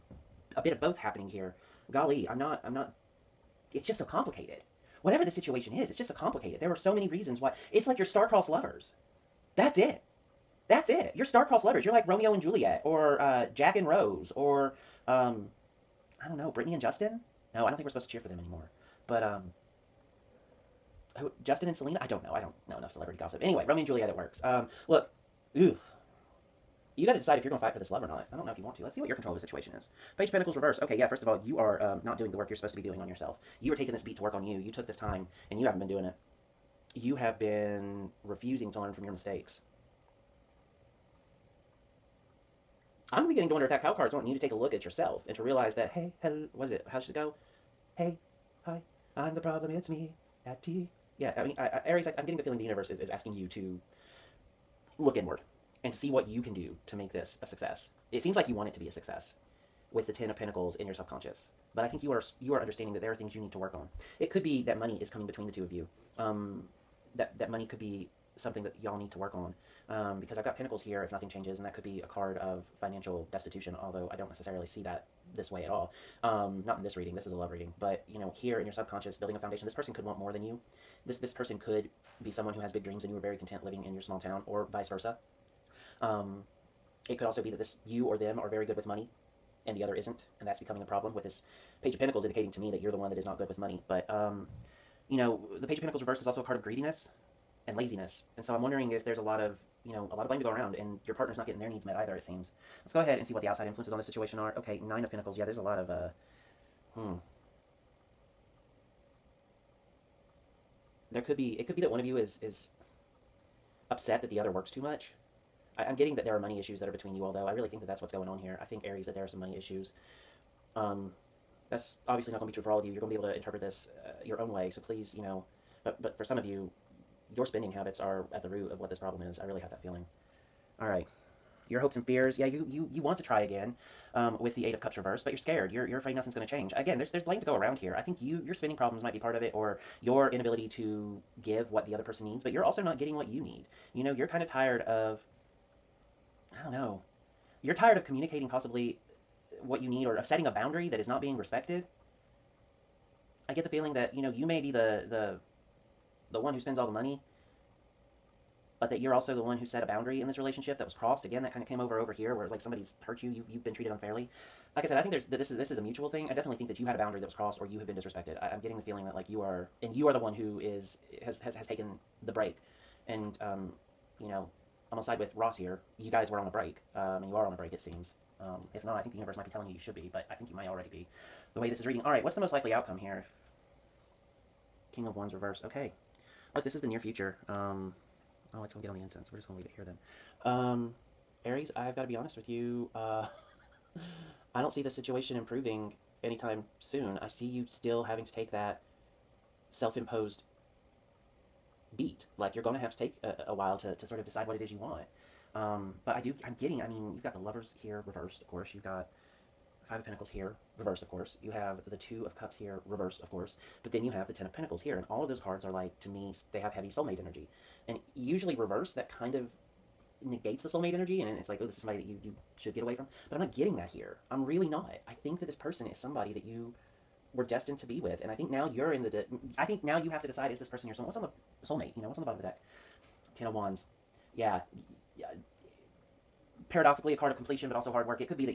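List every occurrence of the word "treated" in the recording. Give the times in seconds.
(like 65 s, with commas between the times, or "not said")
163 s.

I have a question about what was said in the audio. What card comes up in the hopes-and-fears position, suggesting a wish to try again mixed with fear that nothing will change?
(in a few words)
Eight of Cups reversed.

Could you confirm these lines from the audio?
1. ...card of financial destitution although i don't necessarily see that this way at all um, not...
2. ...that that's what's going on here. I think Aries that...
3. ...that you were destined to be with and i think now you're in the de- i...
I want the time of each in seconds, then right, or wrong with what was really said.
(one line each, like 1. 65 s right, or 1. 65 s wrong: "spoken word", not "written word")
1. 72 s right
2. 117 s right
3. 226 s right.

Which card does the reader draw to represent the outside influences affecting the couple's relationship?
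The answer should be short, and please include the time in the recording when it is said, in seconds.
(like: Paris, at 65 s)
Nine of Pentacles, at 104 s.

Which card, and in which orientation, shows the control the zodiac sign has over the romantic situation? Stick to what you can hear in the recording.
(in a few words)
Page of Pentacles reversed.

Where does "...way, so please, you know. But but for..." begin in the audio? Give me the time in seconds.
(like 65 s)
124 s.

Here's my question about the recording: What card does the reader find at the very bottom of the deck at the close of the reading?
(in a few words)
Ten of Wands.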